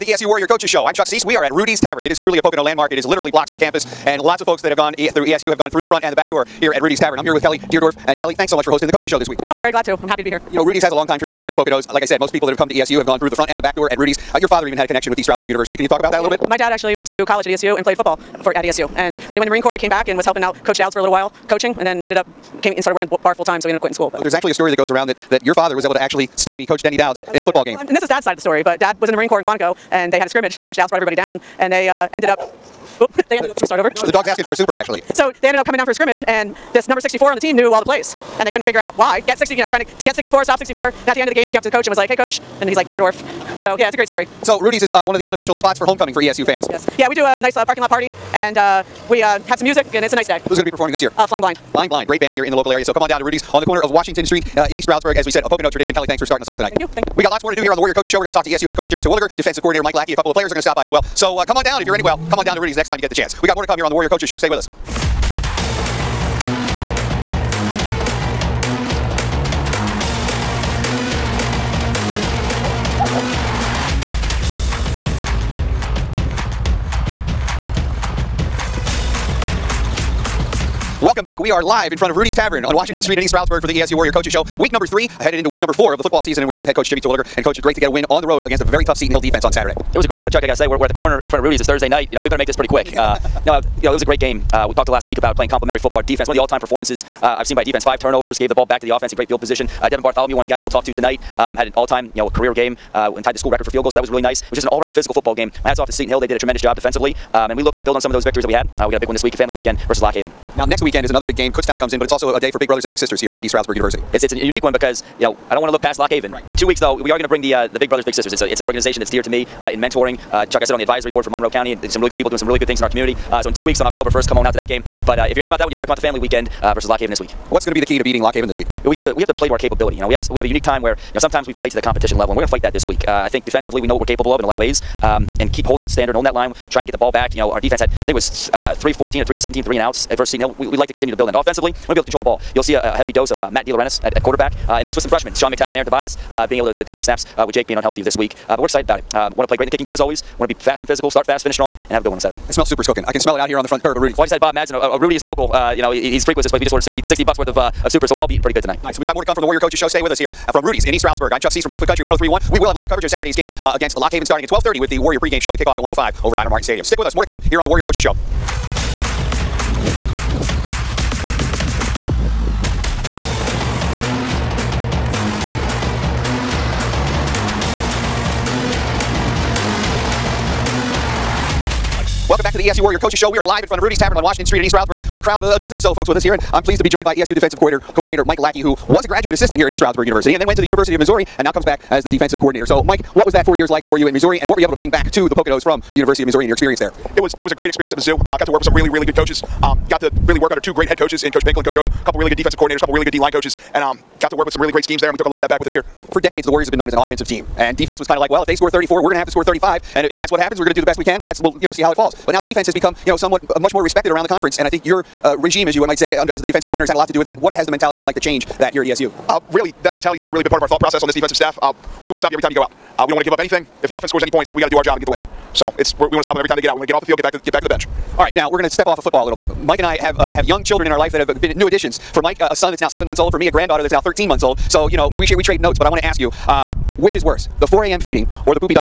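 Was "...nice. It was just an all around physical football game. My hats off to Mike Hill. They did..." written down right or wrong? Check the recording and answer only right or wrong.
wrong.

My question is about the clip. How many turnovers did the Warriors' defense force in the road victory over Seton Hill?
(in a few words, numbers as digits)
5.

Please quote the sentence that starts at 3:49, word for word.
Mike and I have uh, have young children in our life that have been new additions.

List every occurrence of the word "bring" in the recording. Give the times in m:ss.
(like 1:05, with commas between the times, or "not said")
1:57, 3:14.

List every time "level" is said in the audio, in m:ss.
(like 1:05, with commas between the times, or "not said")
2:12.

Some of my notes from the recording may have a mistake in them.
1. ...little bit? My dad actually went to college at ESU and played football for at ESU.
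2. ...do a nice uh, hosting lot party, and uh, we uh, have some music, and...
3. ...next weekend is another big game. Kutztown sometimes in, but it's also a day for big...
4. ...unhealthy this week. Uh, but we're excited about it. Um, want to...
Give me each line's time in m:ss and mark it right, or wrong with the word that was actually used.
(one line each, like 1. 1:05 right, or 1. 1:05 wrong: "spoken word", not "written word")
1. 0:16 right
2. 0:47 wrong: "parking", not "hosting"
3. 1:50 wrong: "comes", not "sometimes"
4. 2:27 right.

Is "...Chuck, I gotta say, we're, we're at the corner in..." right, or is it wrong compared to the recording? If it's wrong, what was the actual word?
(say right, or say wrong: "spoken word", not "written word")
right.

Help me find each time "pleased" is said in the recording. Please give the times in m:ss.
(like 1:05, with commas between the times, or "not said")
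3:06.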